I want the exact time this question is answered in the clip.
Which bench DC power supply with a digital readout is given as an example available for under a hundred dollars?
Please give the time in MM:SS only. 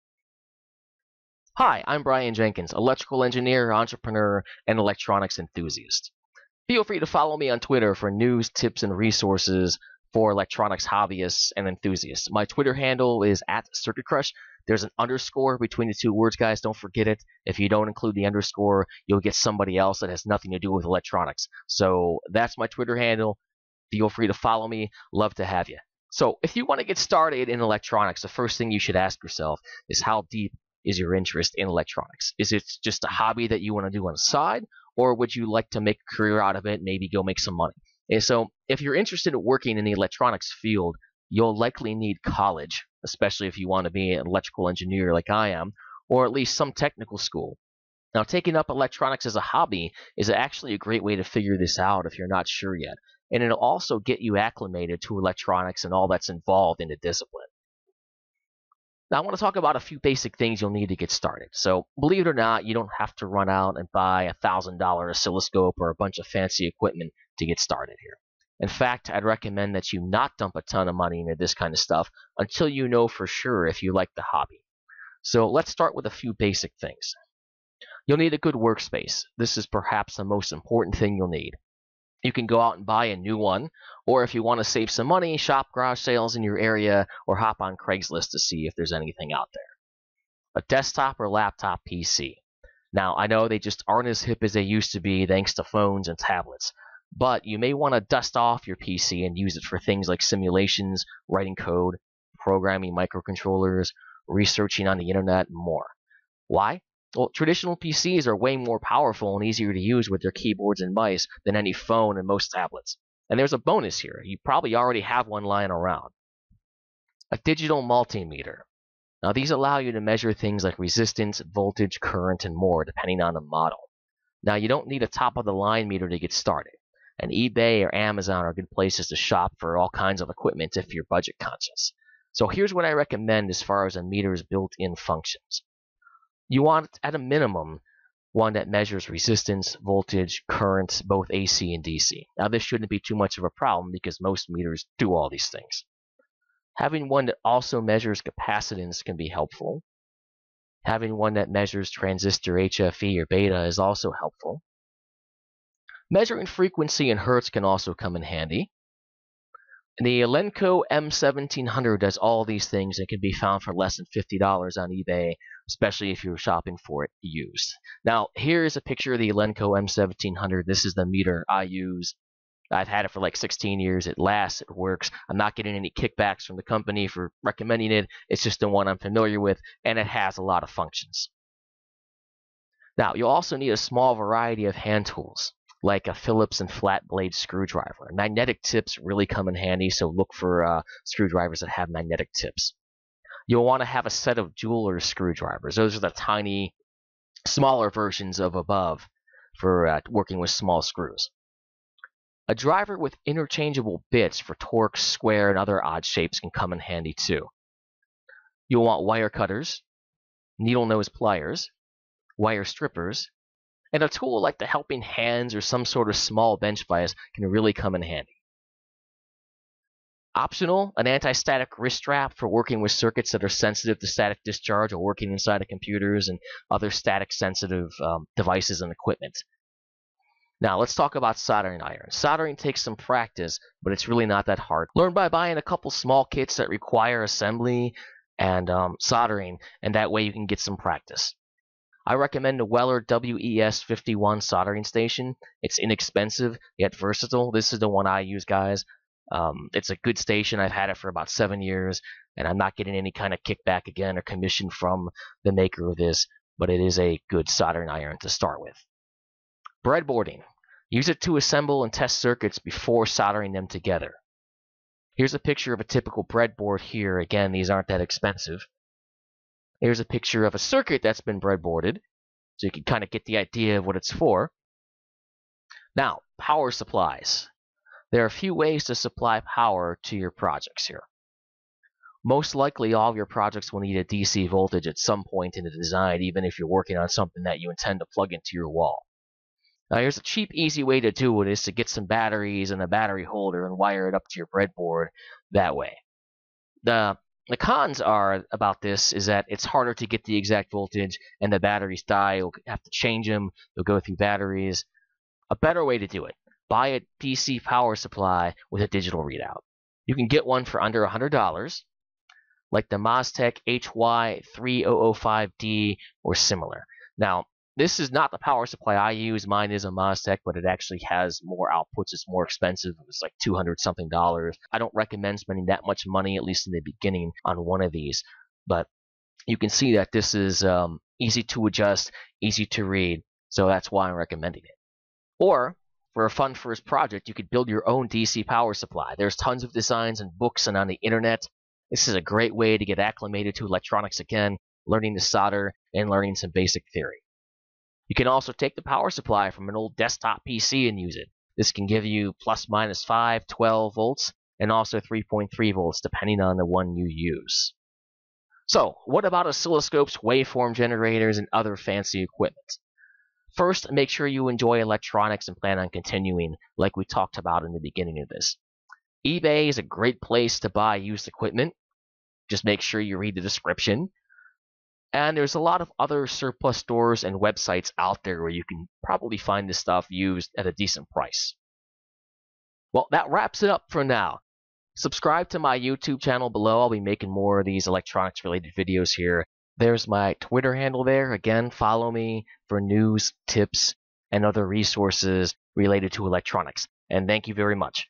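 05:12.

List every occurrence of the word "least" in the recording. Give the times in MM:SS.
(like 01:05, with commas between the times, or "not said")
00:46, 05:26.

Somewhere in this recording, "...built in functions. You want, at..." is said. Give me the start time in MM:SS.
02:14.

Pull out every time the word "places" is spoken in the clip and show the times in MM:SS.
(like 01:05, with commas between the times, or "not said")
02:08, 06:10.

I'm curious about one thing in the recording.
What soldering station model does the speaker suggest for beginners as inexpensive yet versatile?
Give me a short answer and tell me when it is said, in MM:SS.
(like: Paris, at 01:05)
Weller WES51, at 04:02.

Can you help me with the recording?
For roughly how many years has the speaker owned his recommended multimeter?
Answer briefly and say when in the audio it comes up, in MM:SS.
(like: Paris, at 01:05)
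16 years, at 02:53.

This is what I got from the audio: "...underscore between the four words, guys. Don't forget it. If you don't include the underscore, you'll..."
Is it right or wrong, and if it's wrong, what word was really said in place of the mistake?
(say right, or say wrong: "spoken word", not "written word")
wrong: "two", not "four".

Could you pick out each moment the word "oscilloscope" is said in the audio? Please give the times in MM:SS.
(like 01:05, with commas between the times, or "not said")
01:04, 05:59.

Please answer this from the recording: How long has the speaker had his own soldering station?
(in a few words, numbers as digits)
7 years.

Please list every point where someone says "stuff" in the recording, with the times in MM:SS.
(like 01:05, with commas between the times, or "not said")
01:11, 06:19.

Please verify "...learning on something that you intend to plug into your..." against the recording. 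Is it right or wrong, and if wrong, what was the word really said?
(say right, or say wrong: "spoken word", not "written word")
wrong: "working", not "learning".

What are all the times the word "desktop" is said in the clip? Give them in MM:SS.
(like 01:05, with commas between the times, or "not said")
01:30, 05:49.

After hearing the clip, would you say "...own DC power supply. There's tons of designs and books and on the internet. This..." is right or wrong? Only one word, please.
right.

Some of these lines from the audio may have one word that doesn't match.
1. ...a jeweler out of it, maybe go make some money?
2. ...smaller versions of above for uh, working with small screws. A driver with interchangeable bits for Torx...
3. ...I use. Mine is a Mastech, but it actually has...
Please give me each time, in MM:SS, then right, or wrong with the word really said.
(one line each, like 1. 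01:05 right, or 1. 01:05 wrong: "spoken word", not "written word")
1. 00:35 wrong: "career", not "jeweler"
2. 03:17 right
3. 05:18 right.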